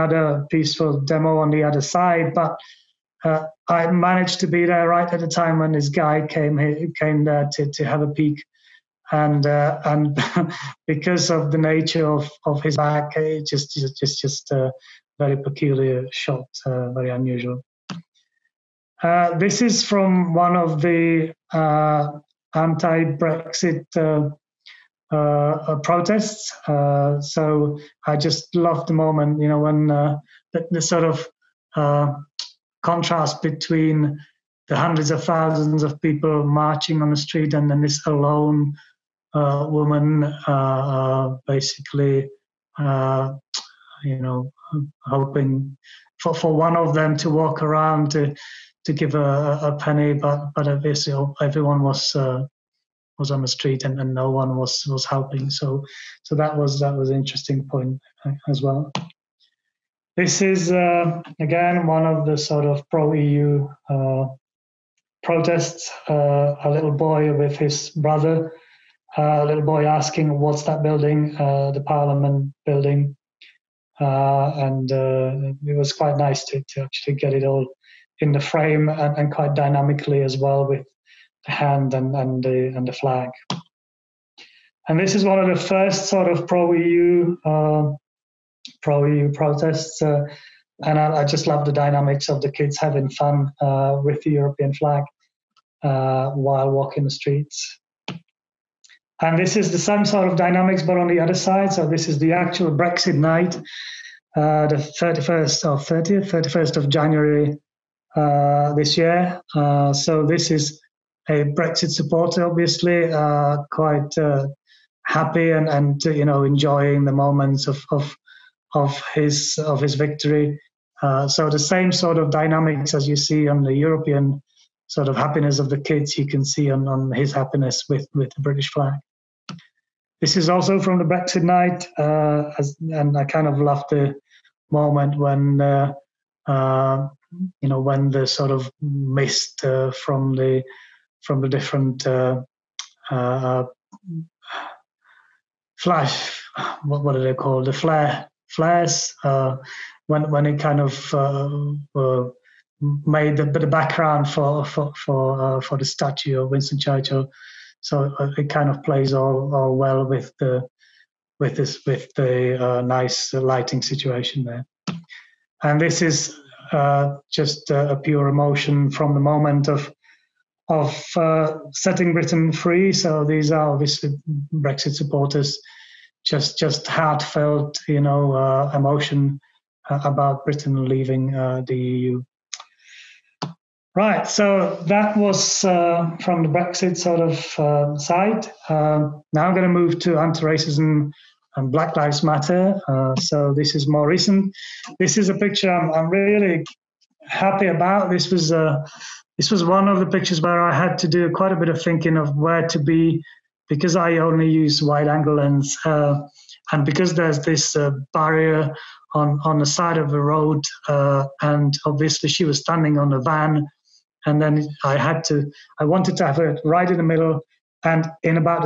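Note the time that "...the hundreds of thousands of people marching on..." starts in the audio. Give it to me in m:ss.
0:34.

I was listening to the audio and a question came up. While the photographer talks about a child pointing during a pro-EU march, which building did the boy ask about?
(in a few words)
Parliament building.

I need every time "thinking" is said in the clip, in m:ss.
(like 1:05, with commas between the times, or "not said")
3:21.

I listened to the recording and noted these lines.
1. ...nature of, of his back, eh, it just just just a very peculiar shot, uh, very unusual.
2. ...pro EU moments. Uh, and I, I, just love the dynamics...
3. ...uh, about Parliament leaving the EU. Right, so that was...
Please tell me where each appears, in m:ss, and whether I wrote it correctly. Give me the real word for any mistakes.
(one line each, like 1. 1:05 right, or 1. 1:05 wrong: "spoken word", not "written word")
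1. 0:11 right
2. 1:28 wrong: "protests", not "moments"
3. 2:59 wrong: "Britain", not "Parliament".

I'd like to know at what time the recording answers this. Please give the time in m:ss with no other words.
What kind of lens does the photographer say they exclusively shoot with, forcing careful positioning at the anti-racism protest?
3:24.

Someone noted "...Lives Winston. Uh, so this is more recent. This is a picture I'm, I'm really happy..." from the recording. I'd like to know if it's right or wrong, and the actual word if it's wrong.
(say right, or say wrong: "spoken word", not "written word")
wrong: "Matter", not "Winston".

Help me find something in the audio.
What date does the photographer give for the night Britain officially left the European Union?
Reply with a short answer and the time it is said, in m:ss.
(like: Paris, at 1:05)
31st of January, at 1:46.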